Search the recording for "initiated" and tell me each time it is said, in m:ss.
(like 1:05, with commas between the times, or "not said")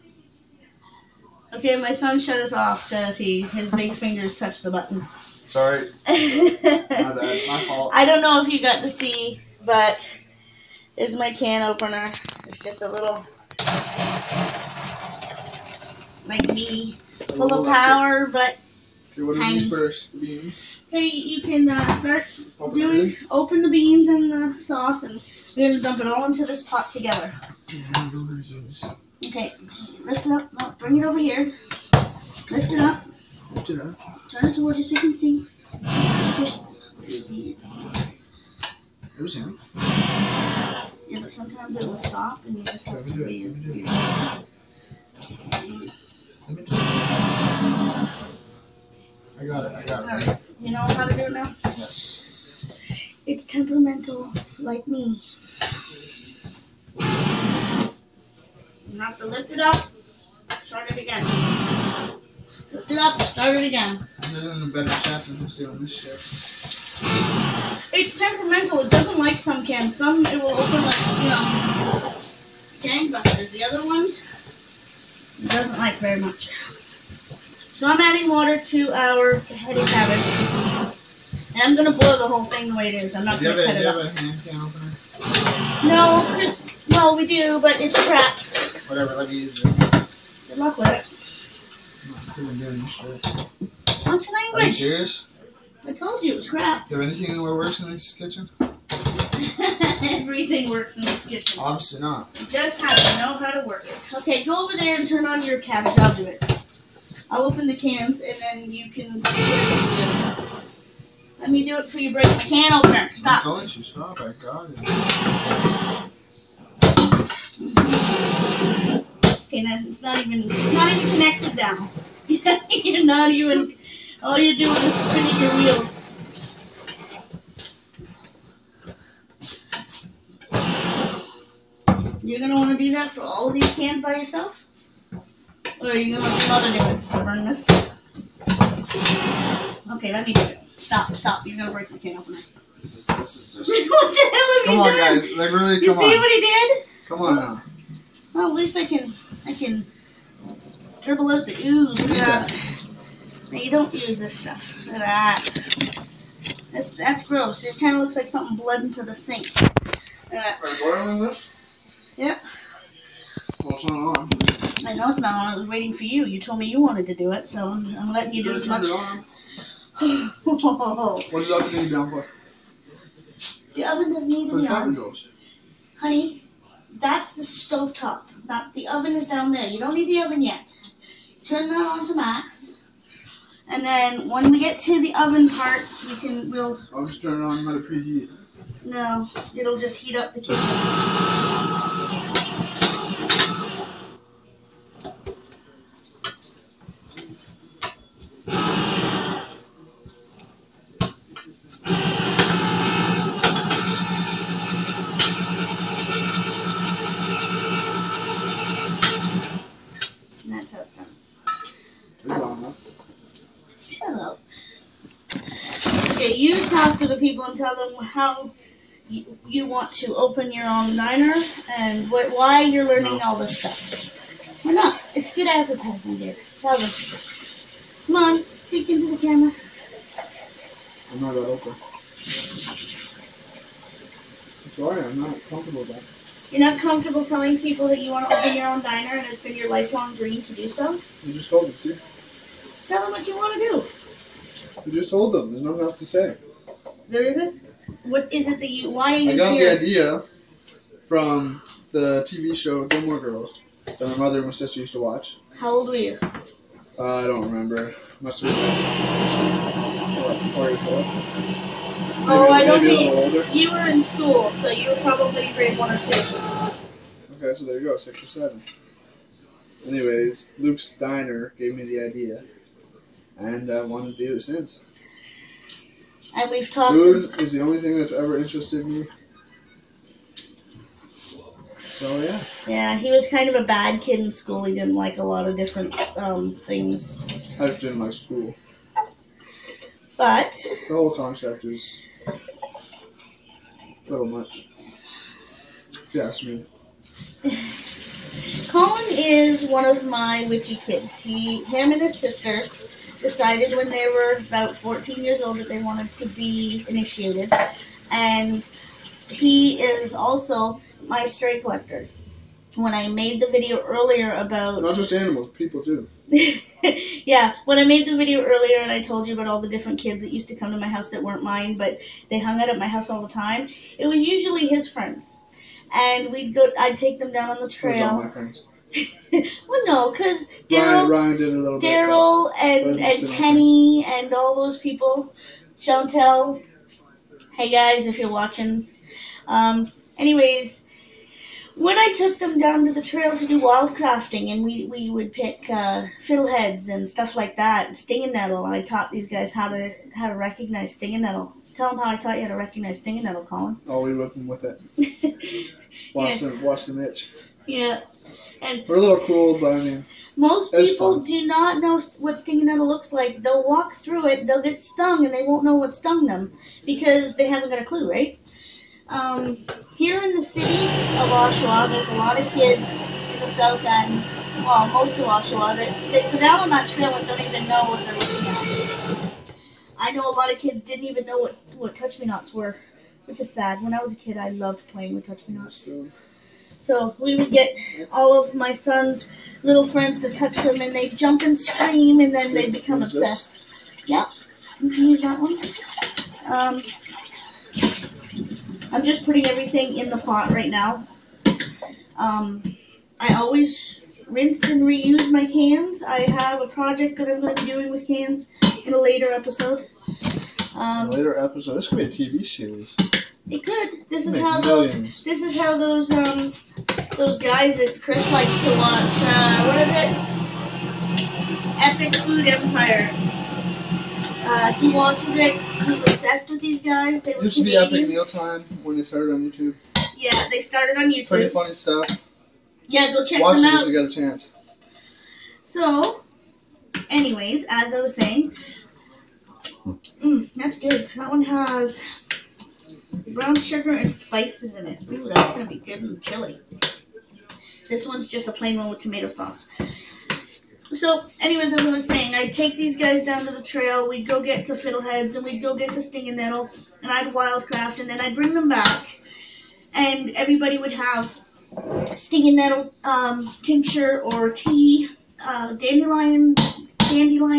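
5:06.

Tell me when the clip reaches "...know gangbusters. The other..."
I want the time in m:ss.
1:11.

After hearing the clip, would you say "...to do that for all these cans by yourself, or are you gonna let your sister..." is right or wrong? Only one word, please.
wrong.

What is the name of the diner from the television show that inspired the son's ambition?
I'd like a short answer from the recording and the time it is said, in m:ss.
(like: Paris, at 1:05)
Luke's diner, at 4:30.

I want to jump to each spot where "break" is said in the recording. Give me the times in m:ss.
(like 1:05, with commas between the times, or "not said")
1:52, 2:21.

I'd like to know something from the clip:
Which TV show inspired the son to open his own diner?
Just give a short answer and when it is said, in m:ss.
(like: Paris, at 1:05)
Gilmore Girls, at 4:12.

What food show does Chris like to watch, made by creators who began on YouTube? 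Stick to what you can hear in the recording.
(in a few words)
Epic Food Empire.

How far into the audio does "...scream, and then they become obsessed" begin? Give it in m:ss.
6:31.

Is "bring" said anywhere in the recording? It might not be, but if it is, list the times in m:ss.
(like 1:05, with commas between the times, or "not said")
0:30, 7:38.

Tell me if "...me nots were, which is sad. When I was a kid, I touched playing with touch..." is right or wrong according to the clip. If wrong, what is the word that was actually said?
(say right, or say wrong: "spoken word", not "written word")
wrong: "loved", not "touched".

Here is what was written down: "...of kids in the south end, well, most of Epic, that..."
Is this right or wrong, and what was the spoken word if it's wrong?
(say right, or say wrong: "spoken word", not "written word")
wrong: "Oshawa", not "Epic".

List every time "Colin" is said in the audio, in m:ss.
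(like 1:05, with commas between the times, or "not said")
4:58, 5:53.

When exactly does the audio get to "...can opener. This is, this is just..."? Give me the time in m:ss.
2:21.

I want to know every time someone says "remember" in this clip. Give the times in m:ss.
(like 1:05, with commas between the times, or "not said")
4:17.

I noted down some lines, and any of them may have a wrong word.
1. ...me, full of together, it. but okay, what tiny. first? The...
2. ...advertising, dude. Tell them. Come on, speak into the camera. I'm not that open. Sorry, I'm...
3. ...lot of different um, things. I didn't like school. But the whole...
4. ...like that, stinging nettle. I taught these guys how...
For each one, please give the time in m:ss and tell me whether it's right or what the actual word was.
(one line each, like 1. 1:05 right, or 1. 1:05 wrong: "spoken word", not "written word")
1. 0:16 wrong: "power", not "together"
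2. 3:45 right
3. 4:45 right
4. 5:47 right.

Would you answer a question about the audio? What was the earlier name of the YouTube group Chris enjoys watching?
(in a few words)
Epic Mealtime.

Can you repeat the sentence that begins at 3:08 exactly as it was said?
No, it'll just heat up the kitchen.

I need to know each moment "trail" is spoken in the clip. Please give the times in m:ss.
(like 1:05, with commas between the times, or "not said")
5:27, 5:43, 6:16, 7:33.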